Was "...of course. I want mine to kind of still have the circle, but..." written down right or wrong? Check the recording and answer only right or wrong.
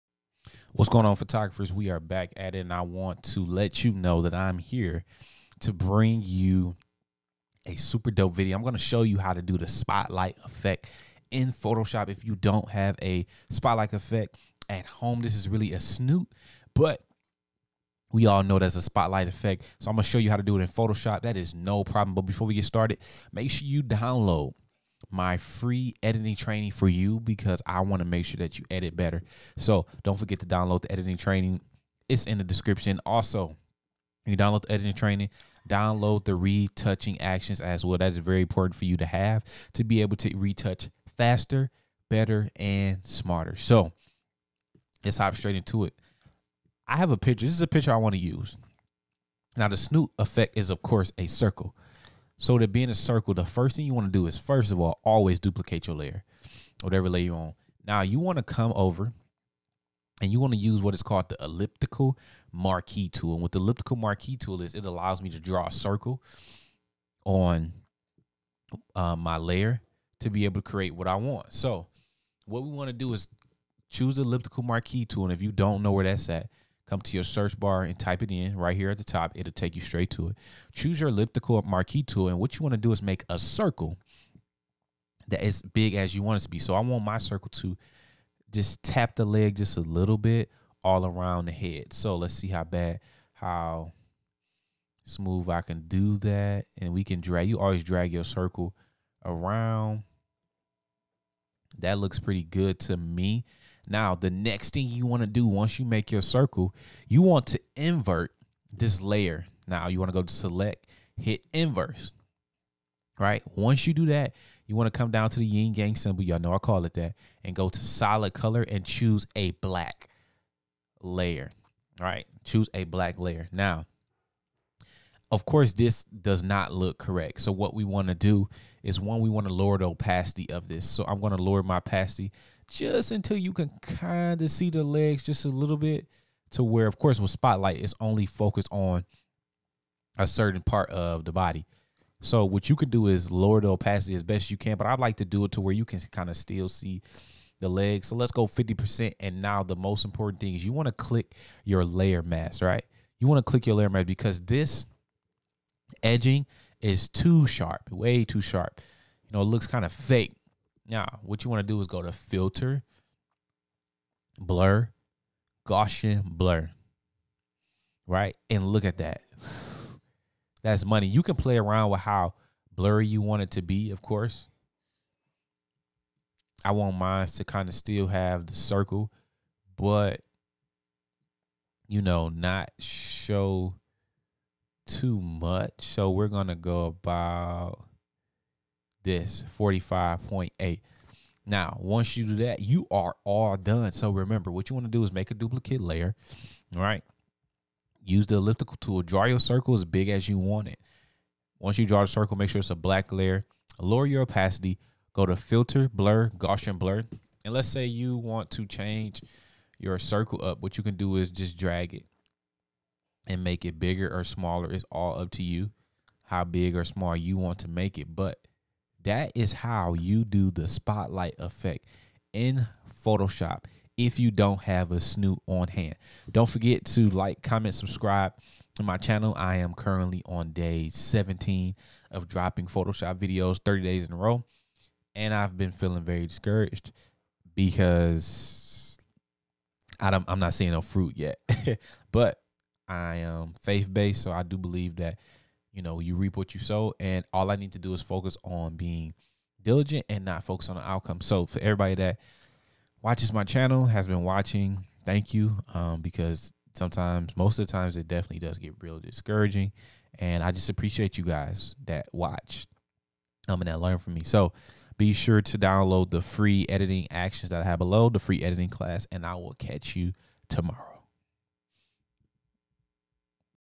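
right.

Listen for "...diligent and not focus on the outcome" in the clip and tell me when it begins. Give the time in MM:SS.
04:09.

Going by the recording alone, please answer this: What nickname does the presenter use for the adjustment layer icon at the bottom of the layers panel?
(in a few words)
yin yang symbol.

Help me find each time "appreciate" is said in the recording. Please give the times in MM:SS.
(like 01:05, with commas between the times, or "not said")
04:20.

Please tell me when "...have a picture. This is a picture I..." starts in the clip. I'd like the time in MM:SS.
00:46.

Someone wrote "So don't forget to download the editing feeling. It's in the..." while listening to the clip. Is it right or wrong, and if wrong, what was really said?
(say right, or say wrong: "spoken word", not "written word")
wrong: "training", not "feeling".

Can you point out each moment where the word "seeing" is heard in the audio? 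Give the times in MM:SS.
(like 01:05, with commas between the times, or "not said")
04:00.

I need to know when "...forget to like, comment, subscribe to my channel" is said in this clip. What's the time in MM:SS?
03:46.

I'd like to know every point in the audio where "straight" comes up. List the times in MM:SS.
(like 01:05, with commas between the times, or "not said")
00:45, 01:19.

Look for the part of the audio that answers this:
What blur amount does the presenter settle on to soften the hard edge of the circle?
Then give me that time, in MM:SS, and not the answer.
03:09.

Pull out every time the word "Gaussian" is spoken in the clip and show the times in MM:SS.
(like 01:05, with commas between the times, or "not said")
02:45, 03:26.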